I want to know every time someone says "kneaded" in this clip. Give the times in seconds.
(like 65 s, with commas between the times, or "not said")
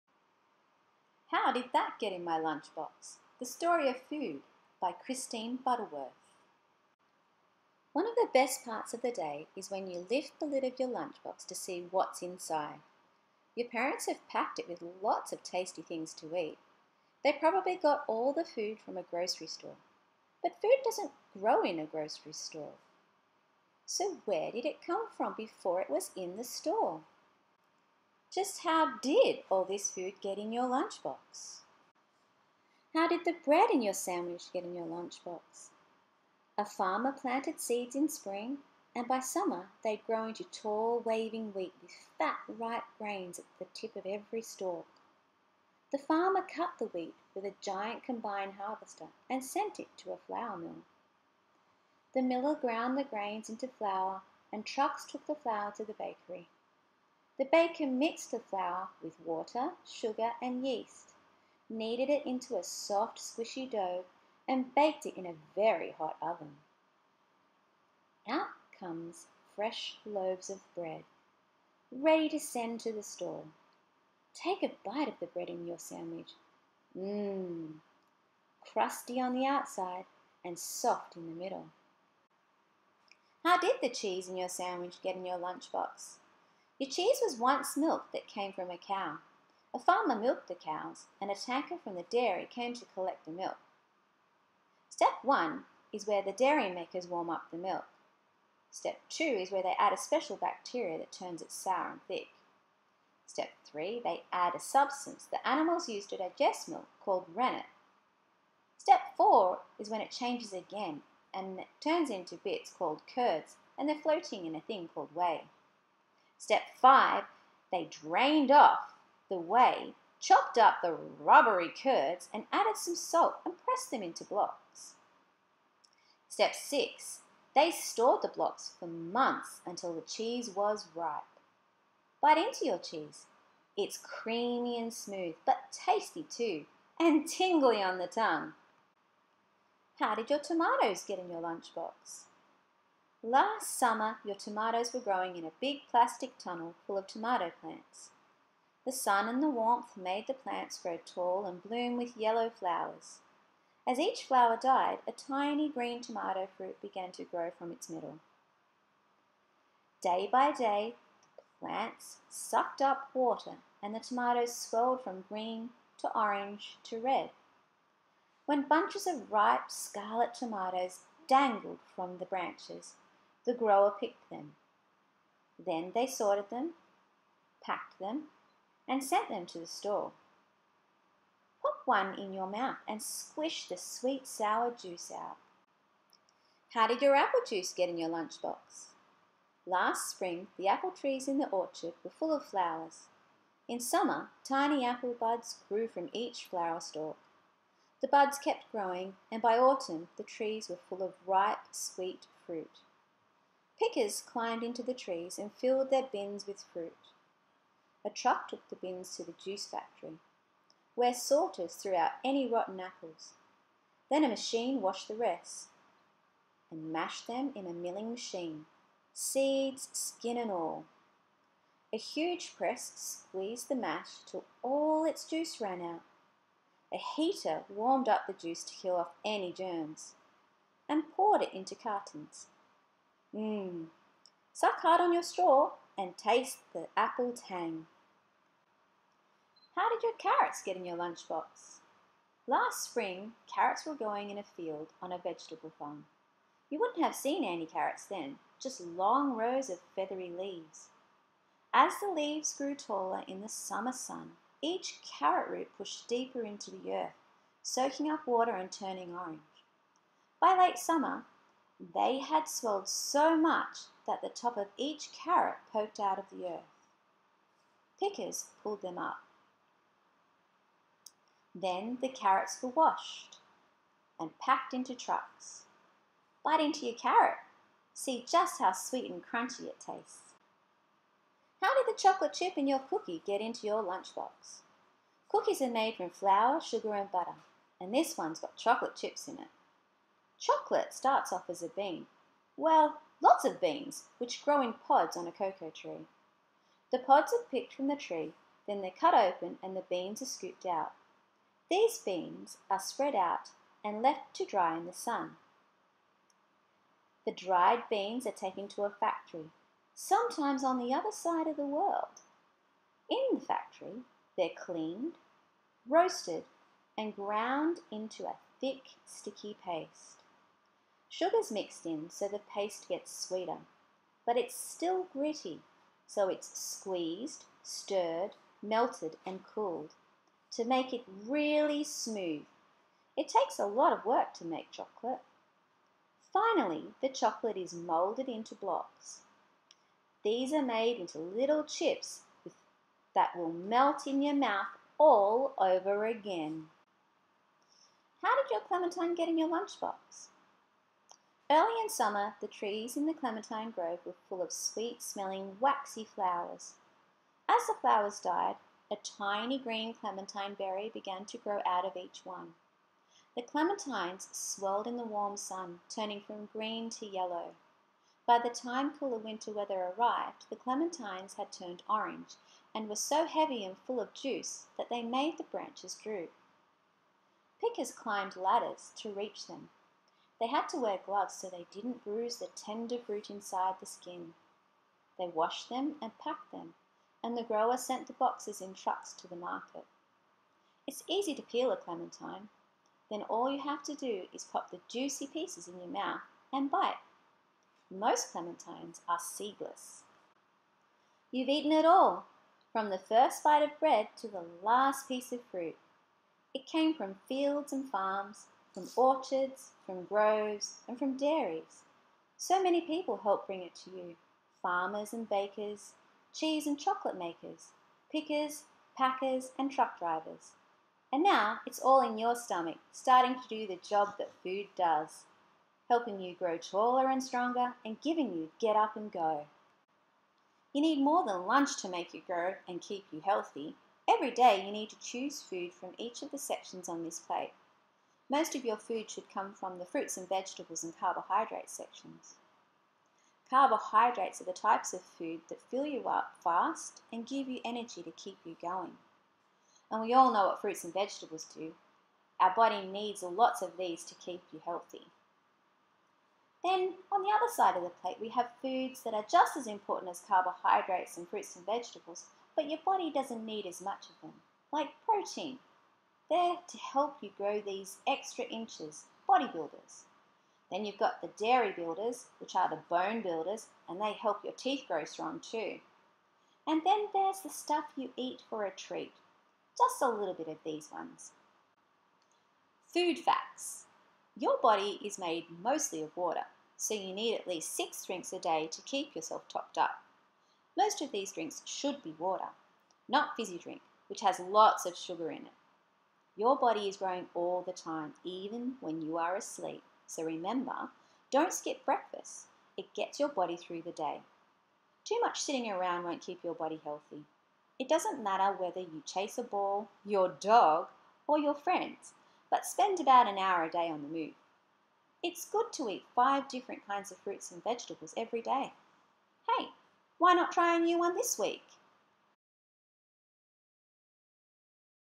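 61 s.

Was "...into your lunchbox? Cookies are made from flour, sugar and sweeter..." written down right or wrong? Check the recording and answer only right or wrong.
wrong.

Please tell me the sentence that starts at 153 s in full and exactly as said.
As each flower died, a tiny green tomato fruit began to grow from its middle.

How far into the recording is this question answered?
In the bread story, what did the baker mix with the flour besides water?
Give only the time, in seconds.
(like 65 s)
59 s.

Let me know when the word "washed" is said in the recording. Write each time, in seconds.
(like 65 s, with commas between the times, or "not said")
214 s, 272 s, 385 s.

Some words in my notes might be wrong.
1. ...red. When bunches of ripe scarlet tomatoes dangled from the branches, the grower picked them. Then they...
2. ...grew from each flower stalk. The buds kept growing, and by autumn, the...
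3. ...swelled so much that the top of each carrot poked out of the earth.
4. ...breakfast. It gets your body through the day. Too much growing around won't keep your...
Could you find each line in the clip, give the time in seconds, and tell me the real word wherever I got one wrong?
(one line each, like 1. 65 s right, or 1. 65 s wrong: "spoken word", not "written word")
1. 166 s right
2. 195 s right
3. 262 s right
4. 501 s wrong: "sitting", not "growing".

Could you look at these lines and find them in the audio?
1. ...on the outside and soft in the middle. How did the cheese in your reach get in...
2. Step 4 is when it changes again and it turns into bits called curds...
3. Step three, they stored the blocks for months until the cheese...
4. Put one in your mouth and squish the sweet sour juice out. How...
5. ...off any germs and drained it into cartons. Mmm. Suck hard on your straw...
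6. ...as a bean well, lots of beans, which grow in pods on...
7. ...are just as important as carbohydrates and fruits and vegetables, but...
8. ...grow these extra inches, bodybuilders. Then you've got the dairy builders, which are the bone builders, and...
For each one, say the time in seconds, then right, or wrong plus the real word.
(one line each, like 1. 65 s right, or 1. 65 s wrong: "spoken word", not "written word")
1. 79 s wrong: "sandwich", not "reach"
2. 108 s right
3. 126 s wrong: "six", not "three"
4. 181 s right
5. 228 s wrong: "poured", not "drained"
6. 291 s right
7. 459 s right
8. 467 s right.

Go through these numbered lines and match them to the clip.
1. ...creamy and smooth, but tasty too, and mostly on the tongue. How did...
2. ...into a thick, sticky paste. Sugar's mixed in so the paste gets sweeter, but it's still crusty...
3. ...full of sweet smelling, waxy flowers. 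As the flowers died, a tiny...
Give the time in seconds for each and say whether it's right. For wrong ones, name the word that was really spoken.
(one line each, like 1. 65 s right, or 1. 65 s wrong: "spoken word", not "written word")
1. 133 s wrong: "tingly", not "mostly"
2. 317 s wrong: "gritty", not "crusty"
3. 354 s right.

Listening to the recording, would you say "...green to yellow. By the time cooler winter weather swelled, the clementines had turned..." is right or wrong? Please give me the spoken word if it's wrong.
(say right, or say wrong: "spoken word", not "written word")
wrong: "arrived", not "swelled".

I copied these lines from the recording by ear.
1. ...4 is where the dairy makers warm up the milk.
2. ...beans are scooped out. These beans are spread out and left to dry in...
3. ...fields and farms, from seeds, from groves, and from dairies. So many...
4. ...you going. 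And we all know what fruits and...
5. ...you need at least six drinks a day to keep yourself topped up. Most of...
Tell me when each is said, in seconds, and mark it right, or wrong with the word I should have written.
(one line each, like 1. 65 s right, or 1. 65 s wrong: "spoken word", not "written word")
1. 95 s wrong: "1", not "4"
2. 299 s right
3. 407 s wrong: "orchards", not "seeds"
4. 448 s right
5. 486 s right.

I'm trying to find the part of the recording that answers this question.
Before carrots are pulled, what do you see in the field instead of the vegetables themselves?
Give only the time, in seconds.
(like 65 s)
249 s.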